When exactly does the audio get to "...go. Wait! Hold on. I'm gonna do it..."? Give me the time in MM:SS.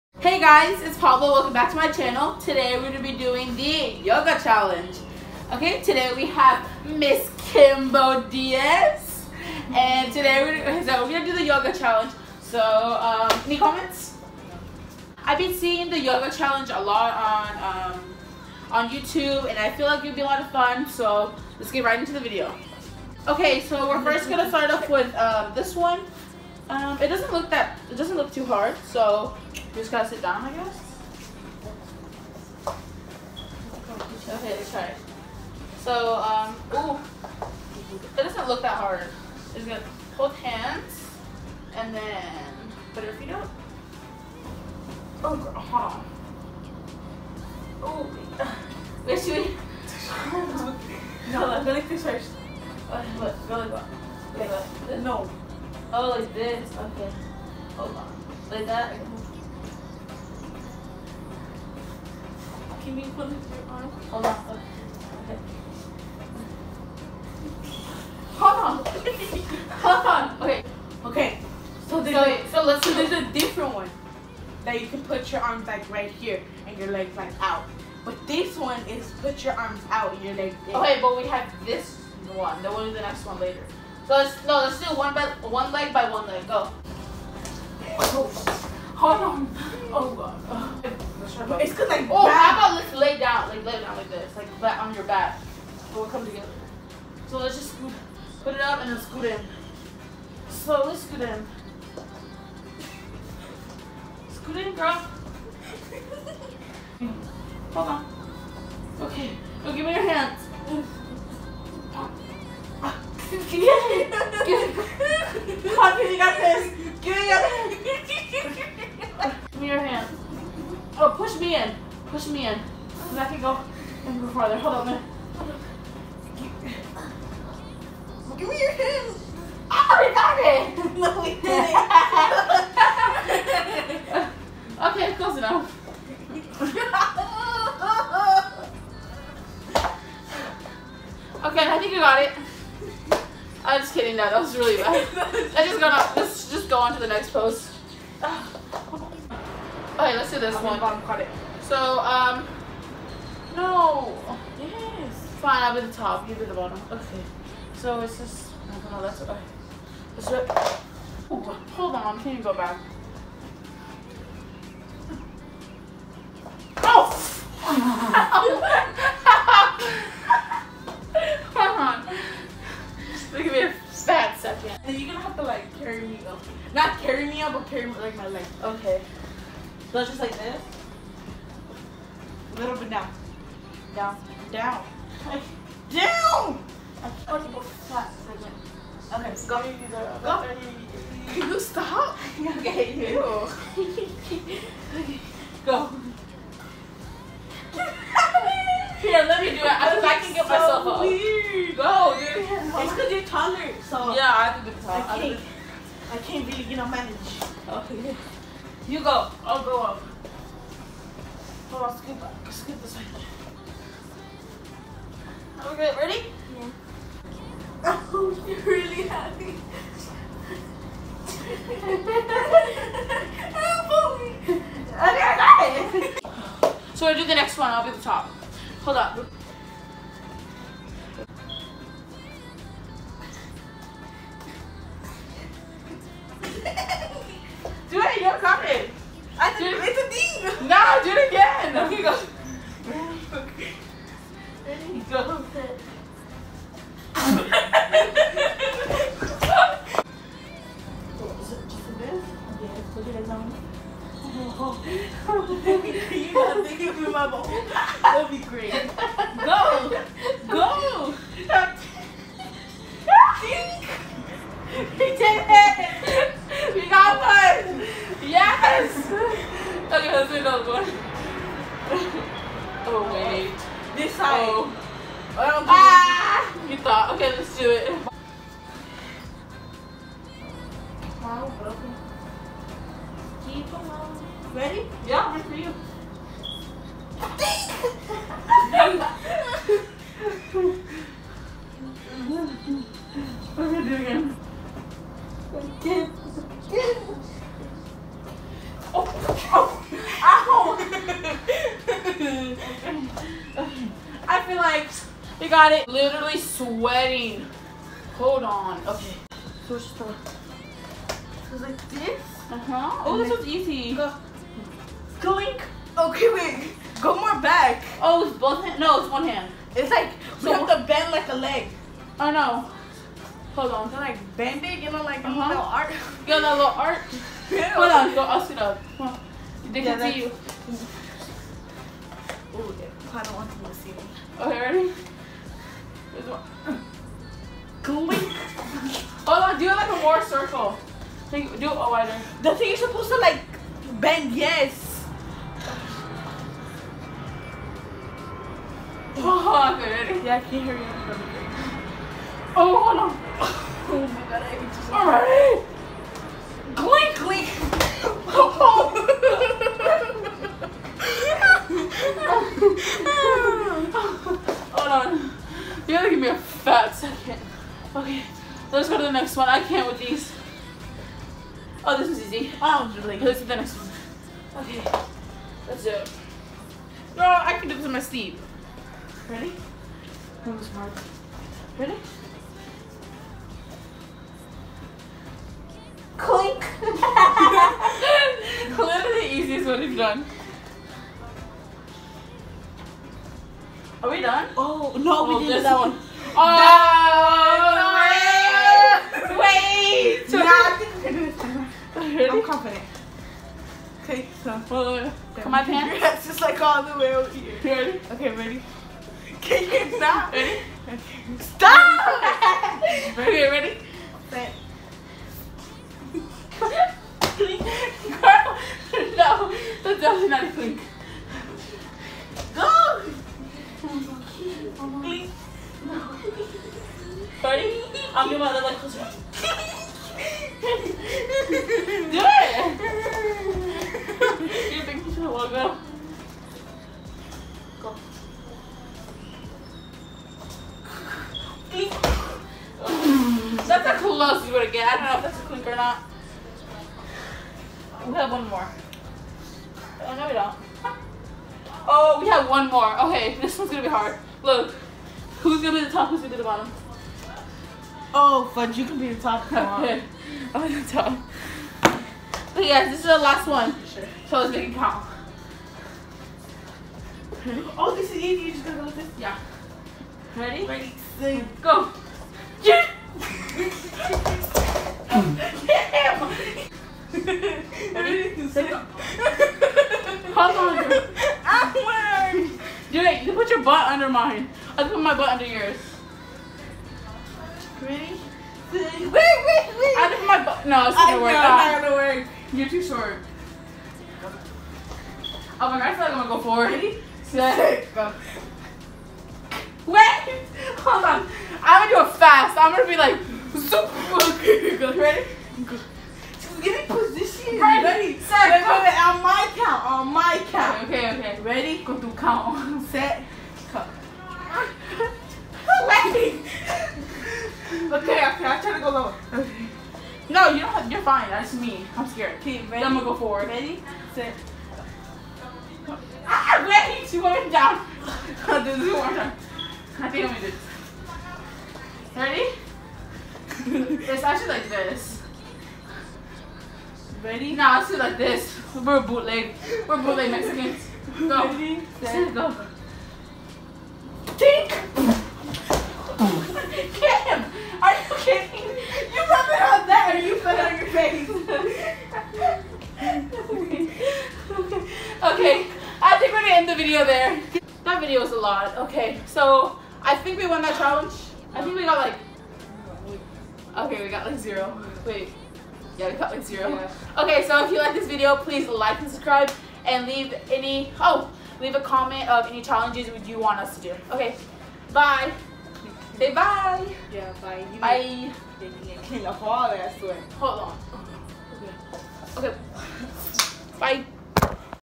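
08:17.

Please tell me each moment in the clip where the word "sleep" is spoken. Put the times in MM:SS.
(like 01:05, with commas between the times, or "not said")
06:17.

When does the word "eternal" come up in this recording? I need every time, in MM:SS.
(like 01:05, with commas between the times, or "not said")
not said.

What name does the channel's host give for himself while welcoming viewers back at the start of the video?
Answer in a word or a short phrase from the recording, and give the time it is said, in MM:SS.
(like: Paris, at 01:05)
Pablo, at 00:00.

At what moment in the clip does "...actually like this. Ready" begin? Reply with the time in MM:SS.
08:54.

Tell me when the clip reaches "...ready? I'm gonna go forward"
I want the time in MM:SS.
08:42.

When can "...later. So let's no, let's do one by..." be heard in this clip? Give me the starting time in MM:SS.
01:23.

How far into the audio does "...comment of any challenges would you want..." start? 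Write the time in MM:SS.
09:31.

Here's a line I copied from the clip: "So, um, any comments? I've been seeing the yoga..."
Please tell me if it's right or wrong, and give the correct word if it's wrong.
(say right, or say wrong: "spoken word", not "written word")
right.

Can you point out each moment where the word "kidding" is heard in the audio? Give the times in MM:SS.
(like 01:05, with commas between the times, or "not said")
02:23, 09:08.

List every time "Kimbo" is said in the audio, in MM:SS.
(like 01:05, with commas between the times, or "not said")
00:07.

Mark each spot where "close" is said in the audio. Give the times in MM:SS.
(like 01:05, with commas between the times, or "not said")
02:15, 07:08, 07:23.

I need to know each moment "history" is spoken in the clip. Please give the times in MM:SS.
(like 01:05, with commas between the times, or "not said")
not said.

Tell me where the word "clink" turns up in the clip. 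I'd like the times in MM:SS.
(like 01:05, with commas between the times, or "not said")
05:37, 05:56, 06:04, 06:26, 07:00, 07:25.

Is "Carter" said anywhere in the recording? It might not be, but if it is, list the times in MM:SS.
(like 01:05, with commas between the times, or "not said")
not said.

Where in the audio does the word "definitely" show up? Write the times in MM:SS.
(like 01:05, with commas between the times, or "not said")
07:00.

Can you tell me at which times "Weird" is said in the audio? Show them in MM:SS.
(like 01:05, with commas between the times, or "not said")
03:21.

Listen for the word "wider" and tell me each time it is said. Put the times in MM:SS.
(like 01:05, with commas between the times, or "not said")
05:41.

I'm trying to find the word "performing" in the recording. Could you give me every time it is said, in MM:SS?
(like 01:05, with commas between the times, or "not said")
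not said.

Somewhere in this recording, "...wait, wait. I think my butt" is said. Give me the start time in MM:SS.
08:09.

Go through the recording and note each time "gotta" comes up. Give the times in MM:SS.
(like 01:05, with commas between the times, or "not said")
00:29, 04:16, 06:05, 07:48.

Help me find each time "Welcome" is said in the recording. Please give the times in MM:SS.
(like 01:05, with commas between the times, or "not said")
00:01.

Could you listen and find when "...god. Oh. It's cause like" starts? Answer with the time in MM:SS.
01:30.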